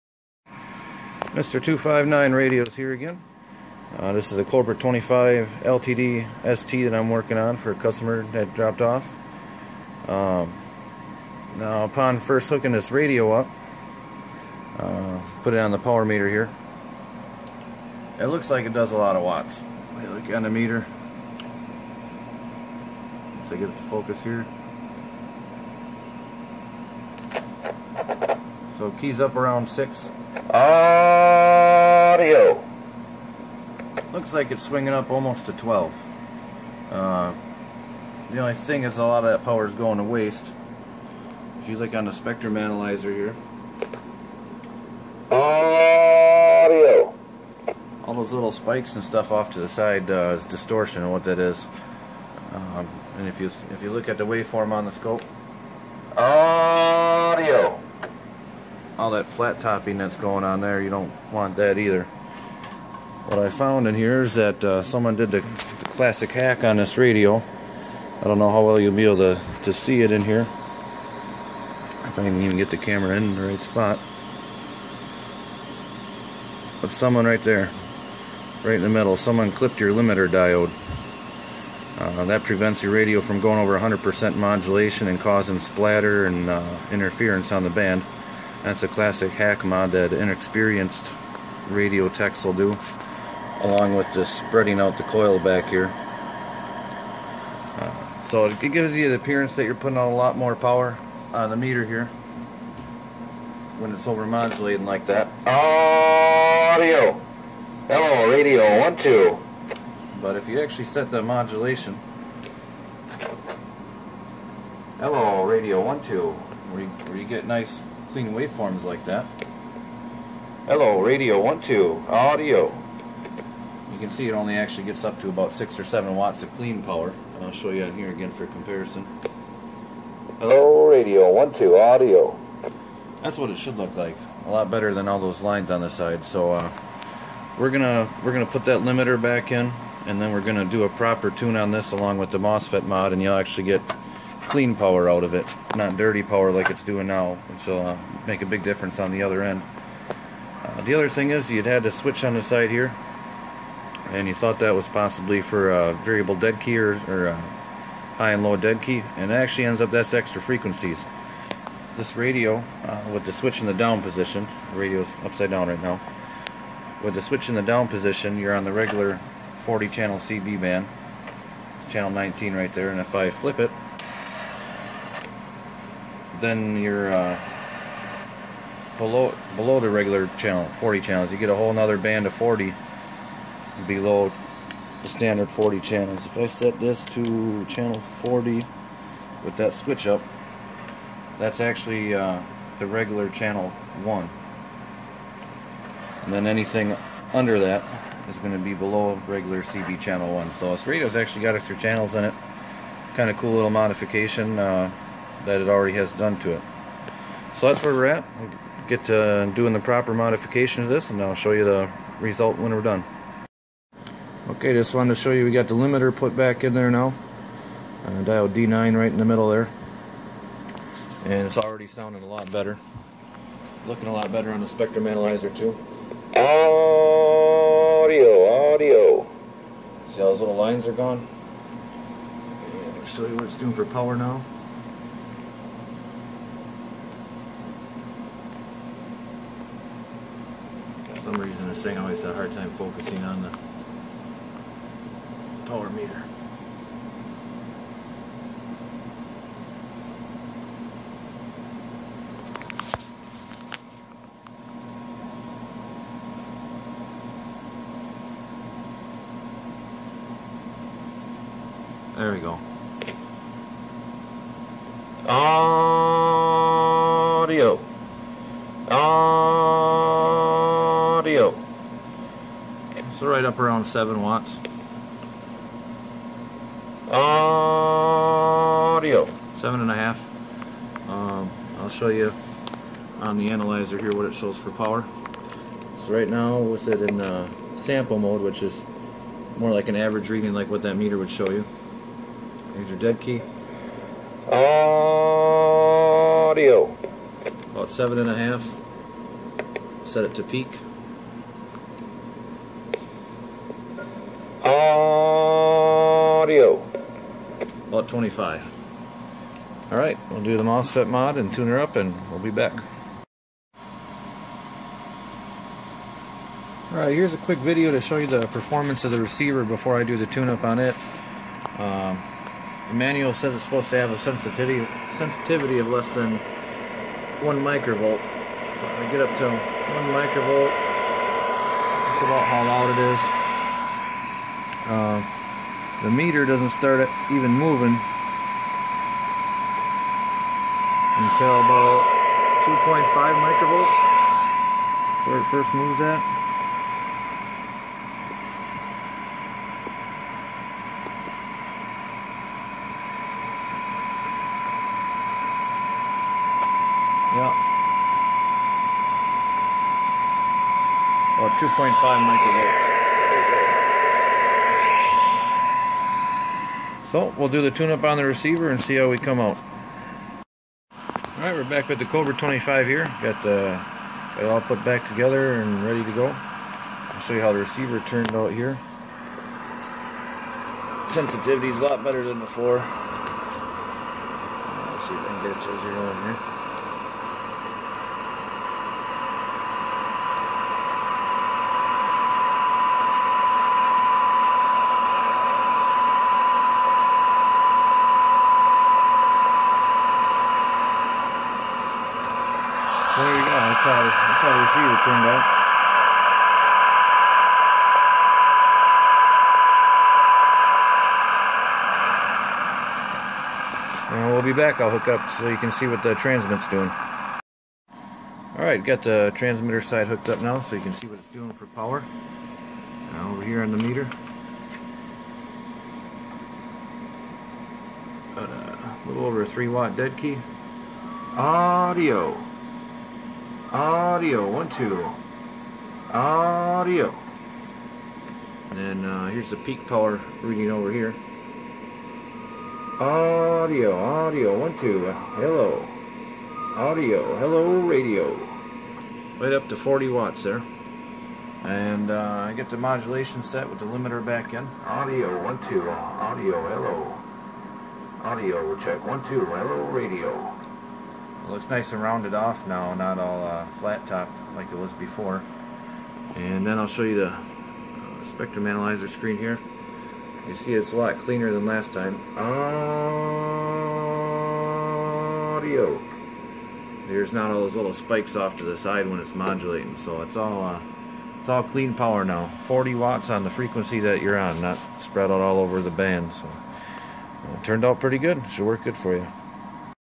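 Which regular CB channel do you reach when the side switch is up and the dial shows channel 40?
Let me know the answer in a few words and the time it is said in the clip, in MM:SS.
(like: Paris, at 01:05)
channel 1, at 03:12.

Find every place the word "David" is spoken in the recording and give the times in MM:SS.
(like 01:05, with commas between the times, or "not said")
not said.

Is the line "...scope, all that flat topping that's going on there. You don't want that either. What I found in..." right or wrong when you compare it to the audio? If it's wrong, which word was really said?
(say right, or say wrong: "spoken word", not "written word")
right.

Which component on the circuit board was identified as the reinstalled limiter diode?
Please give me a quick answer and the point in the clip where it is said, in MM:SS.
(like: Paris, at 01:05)
D9, at 03:38.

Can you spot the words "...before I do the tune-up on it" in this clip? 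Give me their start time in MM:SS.
05:19.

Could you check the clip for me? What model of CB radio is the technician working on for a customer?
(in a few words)
Cobra 25 LTD ST.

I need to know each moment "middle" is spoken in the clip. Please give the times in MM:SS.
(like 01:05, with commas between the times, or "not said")
01:18, 03:39.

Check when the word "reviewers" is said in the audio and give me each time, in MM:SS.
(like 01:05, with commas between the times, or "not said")
not said.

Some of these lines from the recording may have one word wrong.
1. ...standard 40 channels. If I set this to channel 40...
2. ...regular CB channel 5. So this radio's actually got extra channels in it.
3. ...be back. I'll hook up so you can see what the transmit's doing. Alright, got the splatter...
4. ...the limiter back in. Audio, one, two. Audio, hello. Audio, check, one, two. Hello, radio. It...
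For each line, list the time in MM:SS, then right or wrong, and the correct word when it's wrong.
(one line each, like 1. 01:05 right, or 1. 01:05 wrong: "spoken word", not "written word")
1. 03:05 right
2. 03:19 wrong: "1", not "5"
3. 06:54 wrong: "transmitter", not "splatter"
4. 07:33 right.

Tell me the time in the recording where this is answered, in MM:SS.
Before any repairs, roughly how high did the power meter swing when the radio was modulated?
00:35.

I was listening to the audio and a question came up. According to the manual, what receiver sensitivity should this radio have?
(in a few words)
less than 1 microvolt.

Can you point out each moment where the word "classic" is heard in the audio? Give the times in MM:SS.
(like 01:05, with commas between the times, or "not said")
01:05, 01:28.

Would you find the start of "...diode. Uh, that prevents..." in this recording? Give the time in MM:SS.
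01:20.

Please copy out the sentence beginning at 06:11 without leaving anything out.
All right, we're back with the Cobra 25 here.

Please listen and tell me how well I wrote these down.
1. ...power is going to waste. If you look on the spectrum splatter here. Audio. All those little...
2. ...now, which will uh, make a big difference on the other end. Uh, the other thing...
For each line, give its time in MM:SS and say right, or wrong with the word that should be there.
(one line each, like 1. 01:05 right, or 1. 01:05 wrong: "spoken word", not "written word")
1. 00:39 wrong: "analyzer", not "splatter"
2. 02:27 right.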